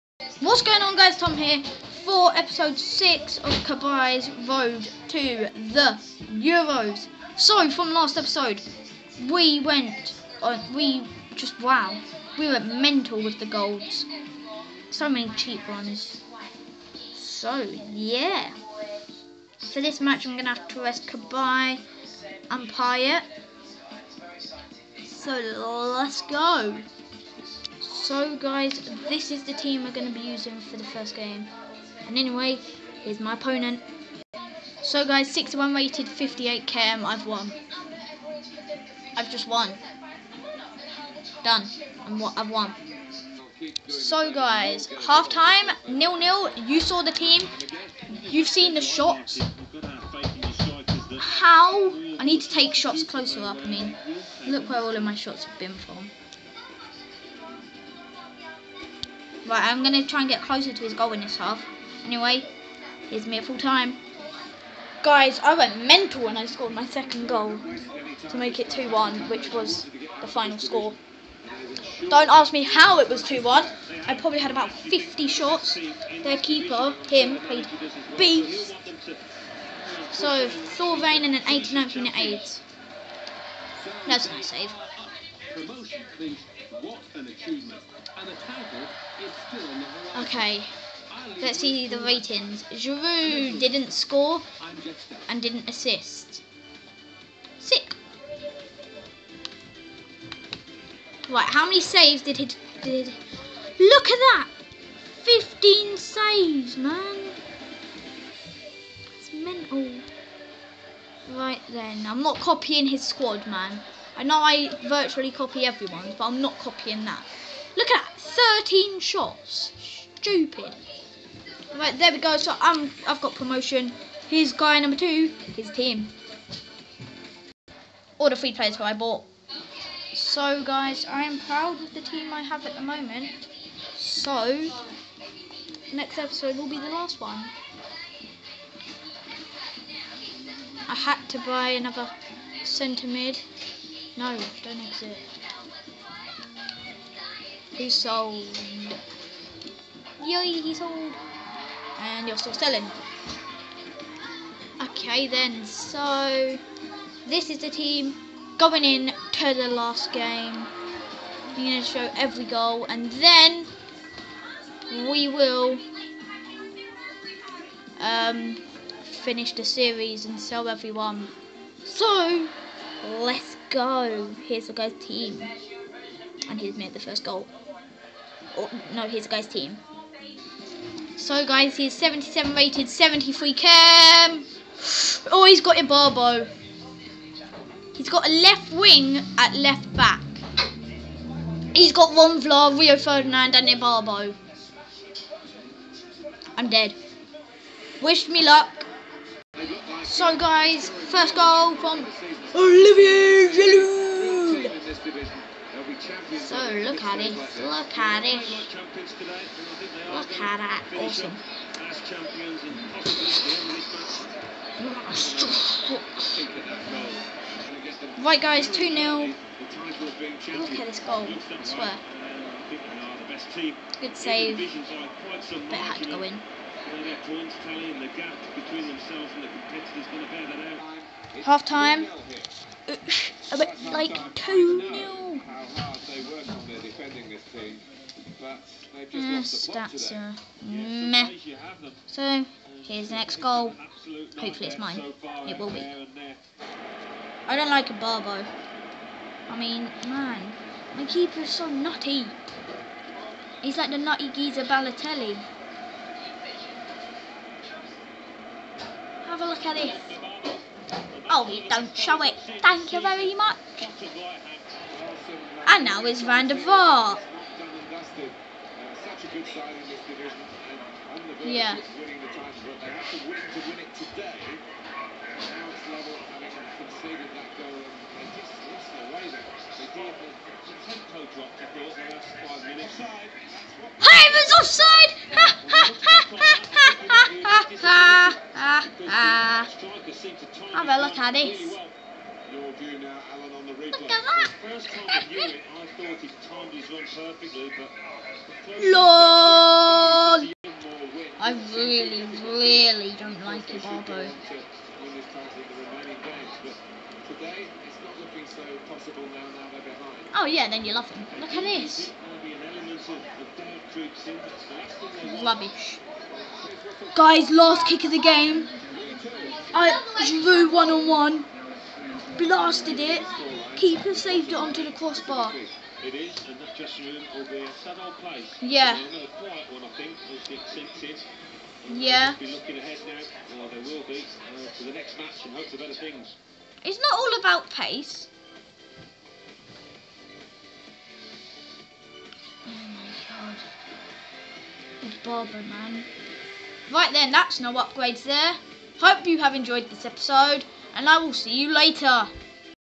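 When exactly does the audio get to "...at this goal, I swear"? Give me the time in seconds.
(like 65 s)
220 s.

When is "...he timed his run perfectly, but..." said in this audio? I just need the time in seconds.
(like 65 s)
296 s.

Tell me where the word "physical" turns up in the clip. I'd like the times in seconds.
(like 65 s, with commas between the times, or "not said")
not said.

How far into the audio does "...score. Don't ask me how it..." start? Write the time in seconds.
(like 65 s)
70 s.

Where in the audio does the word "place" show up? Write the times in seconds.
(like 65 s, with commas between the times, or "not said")
328 s.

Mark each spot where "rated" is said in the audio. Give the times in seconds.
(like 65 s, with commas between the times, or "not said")
35 s, 182 s.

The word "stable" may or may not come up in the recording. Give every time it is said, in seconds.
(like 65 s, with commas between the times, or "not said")
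not said.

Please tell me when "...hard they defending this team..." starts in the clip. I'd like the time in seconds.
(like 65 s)
235 s.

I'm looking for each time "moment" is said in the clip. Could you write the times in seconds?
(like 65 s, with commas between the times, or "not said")
132 s.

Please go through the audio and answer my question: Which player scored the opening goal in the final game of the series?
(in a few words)
Olivier Giroud.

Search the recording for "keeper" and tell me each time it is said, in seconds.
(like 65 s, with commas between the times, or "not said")
76 s, 251 s, 323 s.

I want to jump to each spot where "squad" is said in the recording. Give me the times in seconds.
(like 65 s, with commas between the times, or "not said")
113 s.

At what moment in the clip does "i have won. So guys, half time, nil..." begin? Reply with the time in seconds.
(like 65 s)
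42 s.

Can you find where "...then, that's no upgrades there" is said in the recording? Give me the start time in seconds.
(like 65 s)
347 s.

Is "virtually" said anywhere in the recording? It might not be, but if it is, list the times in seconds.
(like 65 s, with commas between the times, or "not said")
114 s.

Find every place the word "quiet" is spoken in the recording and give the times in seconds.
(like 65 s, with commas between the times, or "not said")
329 s.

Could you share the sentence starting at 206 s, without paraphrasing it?
So look at it, look at it, look at that, awesome.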